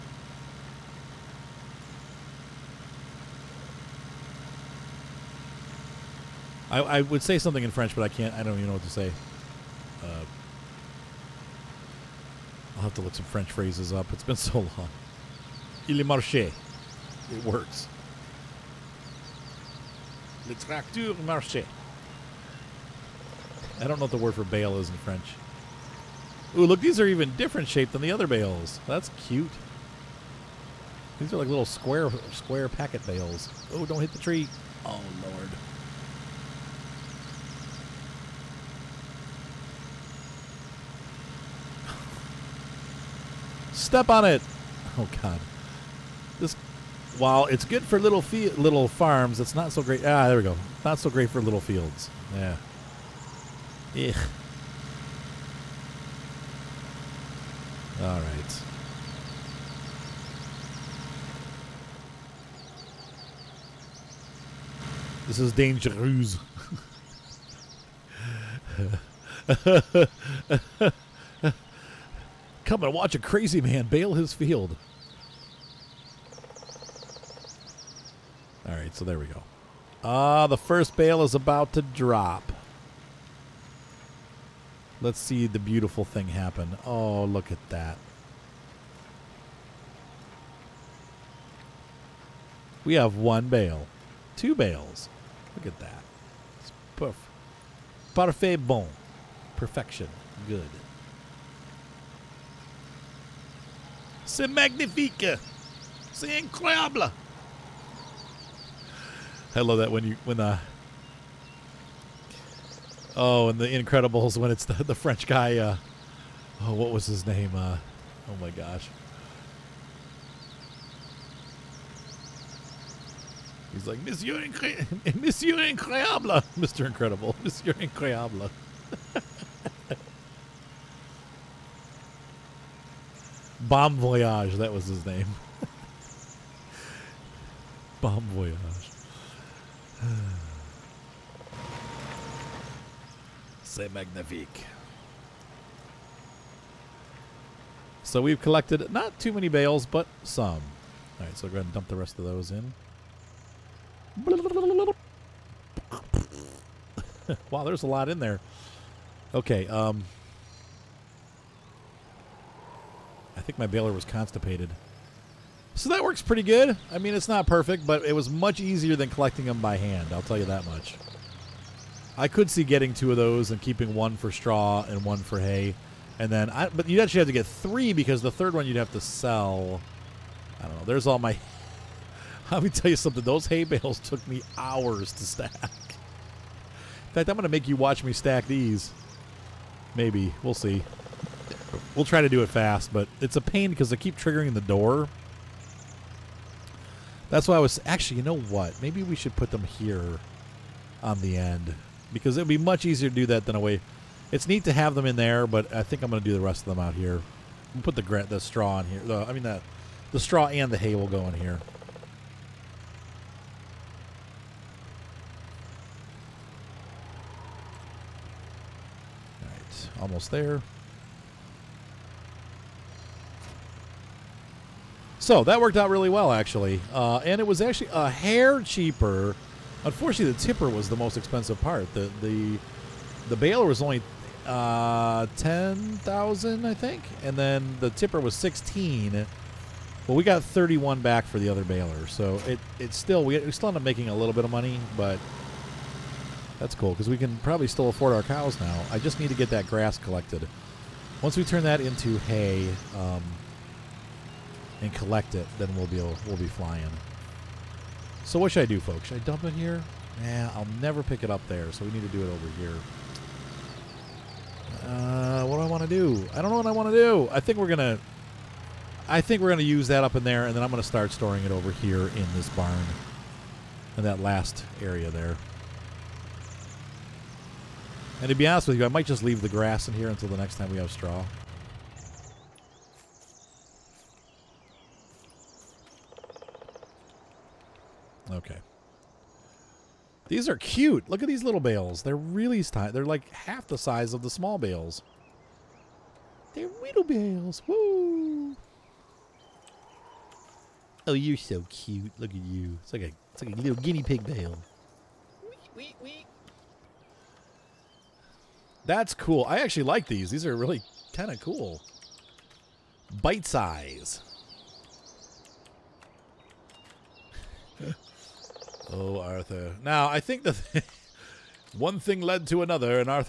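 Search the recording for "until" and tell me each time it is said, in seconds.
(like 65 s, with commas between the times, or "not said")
280 s.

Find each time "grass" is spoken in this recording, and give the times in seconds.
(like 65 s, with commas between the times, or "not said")
249 s, 279 s.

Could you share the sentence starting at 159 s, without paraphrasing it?
Okay, um, think my baler was constipated.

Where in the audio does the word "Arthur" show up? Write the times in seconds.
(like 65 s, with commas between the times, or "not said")
319 s.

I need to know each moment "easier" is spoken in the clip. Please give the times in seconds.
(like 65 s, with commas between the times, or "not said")
168 s, 202 s.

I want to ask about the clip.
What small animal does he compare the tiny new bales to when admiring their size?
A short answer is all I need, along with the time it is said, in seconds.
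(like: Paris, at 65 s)
Guinea pig, at 303 s.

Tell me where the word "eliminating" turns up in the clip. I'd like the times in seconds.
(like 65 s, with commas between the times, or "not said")
not said.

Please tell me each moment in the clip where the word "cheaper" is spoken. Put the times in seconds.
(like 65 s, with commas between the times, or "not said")
228 s.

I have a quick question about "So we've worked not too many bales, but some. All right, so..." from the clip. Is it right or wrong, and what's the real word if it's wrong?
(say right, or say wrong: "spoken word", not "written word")
wrong: "collected", not "worked".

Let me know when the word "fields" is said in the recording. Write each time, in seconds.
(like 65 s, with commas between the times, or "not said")
51 s, 74 s.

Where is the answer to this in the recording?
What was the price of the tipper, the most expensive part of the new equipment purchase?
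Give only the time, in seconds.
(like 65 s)
238 s.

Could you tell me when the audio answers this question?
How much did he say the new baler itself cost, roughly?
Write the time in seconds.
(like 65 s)
235 s.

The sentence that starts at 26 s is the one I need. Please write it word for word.
Ooh, look, these are even different shaped than the other bales.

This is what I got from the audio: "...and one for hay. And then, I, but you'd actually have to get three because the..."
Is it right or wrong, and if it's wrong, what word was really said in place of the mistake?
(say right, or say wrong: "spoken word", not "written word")
right.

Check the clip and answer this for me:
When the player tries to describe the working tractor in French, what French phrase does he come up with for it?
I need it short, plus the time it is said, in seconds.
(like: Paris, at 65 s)
Le tracteur marché, at 20 s.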